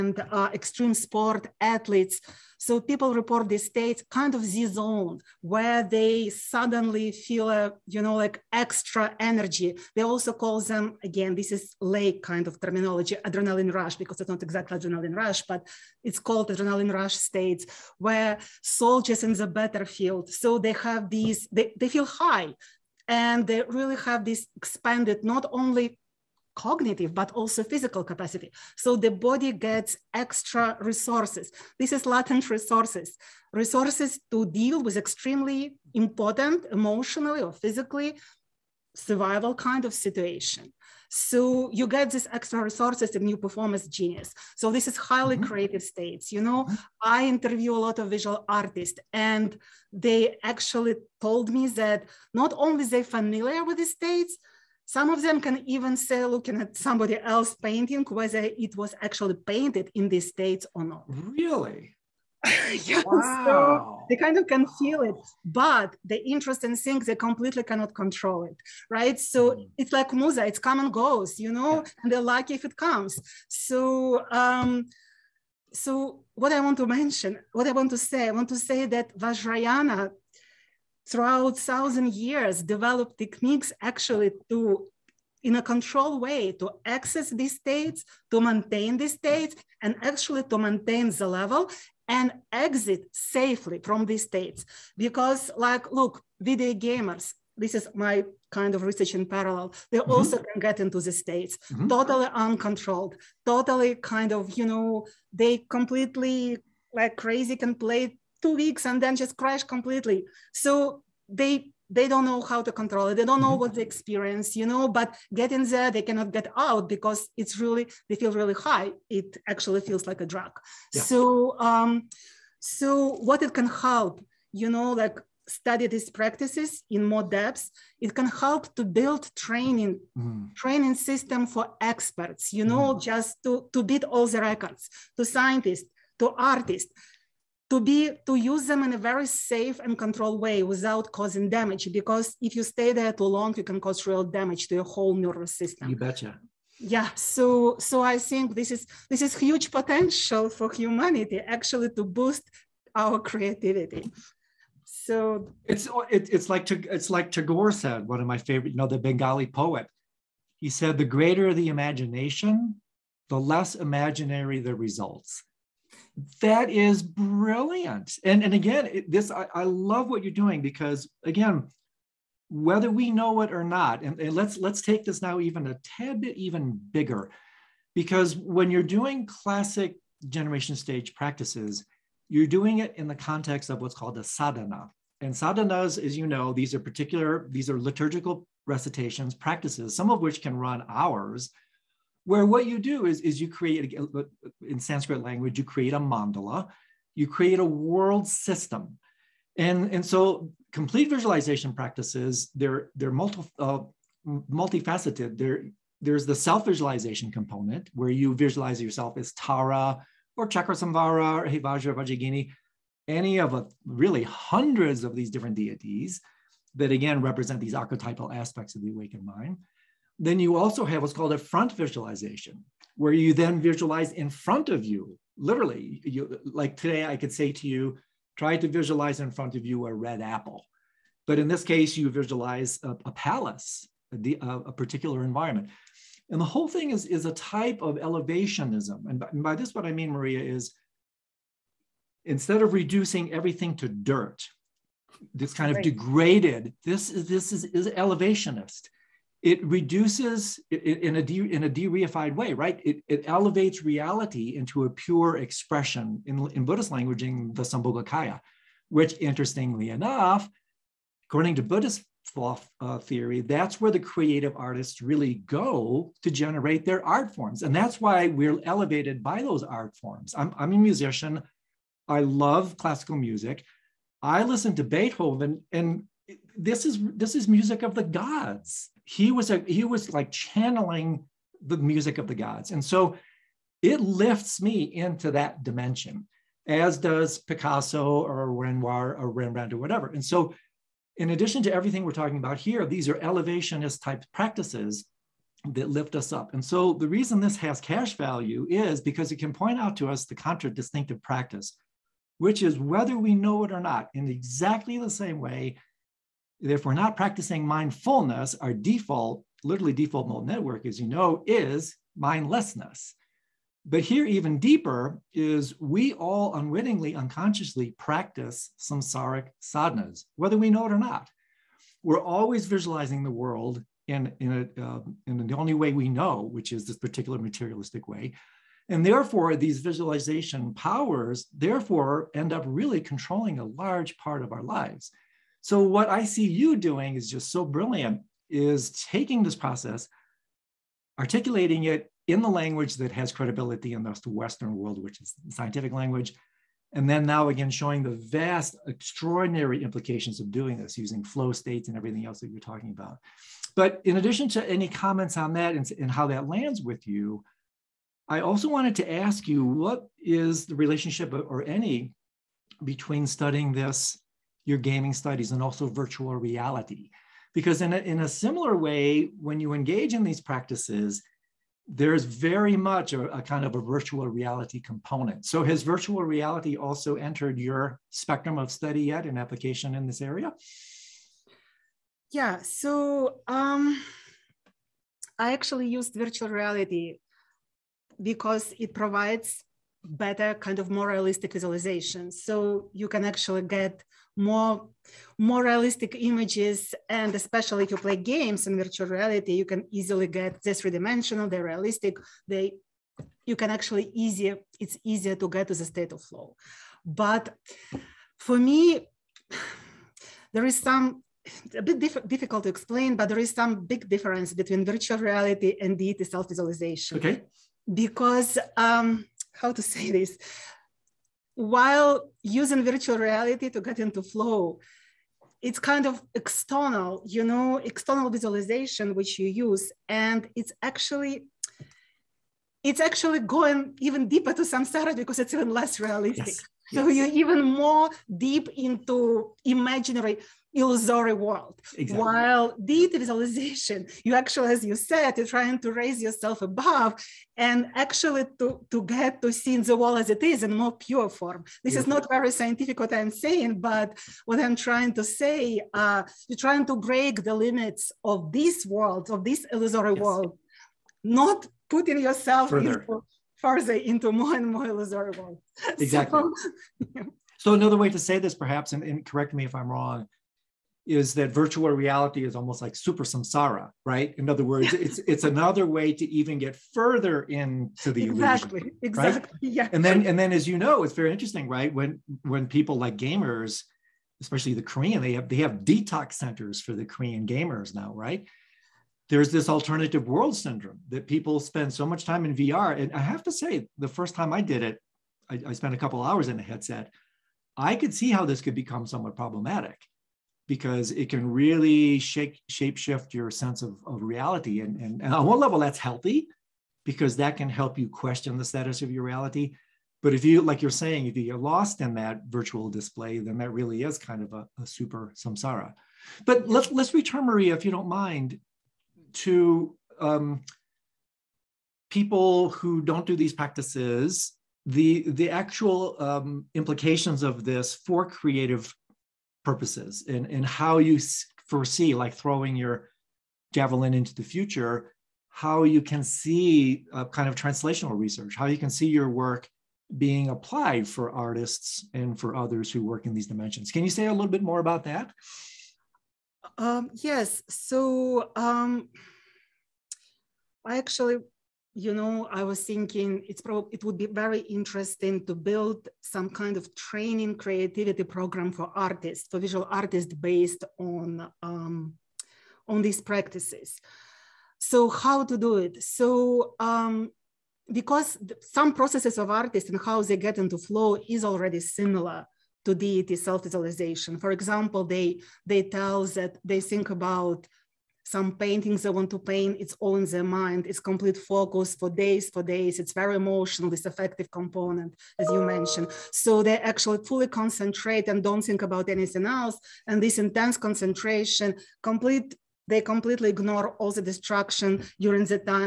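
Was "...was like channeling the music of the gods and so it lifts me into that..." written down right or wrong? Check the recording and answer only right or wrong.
right.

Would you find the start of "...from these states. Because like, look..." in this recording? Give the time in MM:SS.
01:33.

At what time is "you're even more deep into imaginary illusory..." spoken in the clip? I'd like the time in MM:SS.
07:17.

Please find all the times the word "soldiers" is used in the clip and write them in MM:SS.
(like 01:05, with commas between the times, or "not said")
00:18.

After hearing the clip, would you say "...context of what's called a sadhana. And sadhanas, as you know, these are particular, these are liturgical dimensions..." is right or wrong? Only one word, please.
wrong.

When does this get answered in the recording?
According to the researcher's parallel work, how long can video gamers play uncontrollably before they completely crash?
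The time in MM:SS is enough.
01:48.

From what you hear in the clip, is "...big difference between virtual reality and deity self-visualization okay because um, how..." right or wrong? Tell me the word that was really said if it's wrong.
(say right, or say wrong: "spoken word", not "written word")
right.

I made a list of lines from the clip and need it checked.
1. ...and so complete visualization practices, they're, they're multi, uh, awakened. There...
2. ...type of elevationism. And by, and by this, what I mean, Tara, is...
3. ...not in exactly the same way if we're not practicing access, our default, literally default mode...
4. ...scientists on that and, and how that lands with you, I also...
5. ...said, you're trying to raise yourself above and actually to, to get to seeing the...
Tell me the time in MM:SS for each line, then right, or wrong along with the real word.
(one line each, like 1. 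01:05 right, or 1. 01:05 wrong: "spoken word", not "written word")
1. 03:19 wrong: "multifaceted", not "awakened"
2. 03:57 wrong: "Maria", not "Tara"
3. 05:03 wrong: "mindfulness", not "access"
4. 05:54 wrong: "comments", not "scientists"
5. 07:24 right.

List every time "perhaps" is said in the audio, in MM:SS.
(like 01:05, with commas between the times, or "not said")
07:48.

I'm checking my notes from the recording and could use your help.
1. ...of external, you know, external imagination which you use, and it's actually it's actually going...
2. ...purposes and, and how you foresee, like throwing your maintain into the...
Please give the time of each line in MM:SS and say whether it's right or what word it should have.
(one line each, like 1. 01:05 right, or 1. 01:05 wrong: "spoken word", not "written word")
1. 07:06 wrong: "visualization", not "imagination"
2. 08:49 wrong: "javelin", not "maintain".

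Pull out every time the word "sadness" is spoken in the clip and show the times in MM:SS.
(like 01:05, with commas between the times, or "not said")
not said.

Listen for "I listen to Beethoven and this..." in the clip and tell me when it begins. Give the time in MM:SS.
04:34.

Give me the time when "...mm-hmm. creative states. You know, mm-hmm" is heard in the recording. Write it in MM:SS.
00:45.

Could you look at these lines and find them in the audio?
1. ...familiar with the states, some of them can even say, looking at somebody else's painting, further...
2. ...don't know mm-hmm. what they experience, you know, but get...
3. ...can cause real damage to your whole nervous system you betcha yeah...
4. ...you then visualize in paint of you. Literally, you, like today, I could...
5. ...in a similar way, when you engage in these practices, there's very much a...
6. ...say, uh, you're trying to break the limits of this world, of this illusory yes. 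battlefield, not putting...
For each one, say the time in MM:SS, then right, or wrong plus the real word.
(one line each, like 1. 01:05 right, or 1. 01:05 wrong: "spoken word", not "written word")
1. 00:53 wrong: "whether", not "further"
2. 01:53 right
3. 02:23 right
4. 03:43 wrong: "front", not "paint"
5. 06:07 right
6. 07:35 wrong: "world", not "battlefield".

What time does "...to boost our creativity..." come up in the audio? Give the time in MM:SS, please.
02:31.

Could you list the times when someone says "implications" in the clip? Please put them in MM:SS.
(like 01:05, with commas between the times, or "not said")
05:49, 08:46.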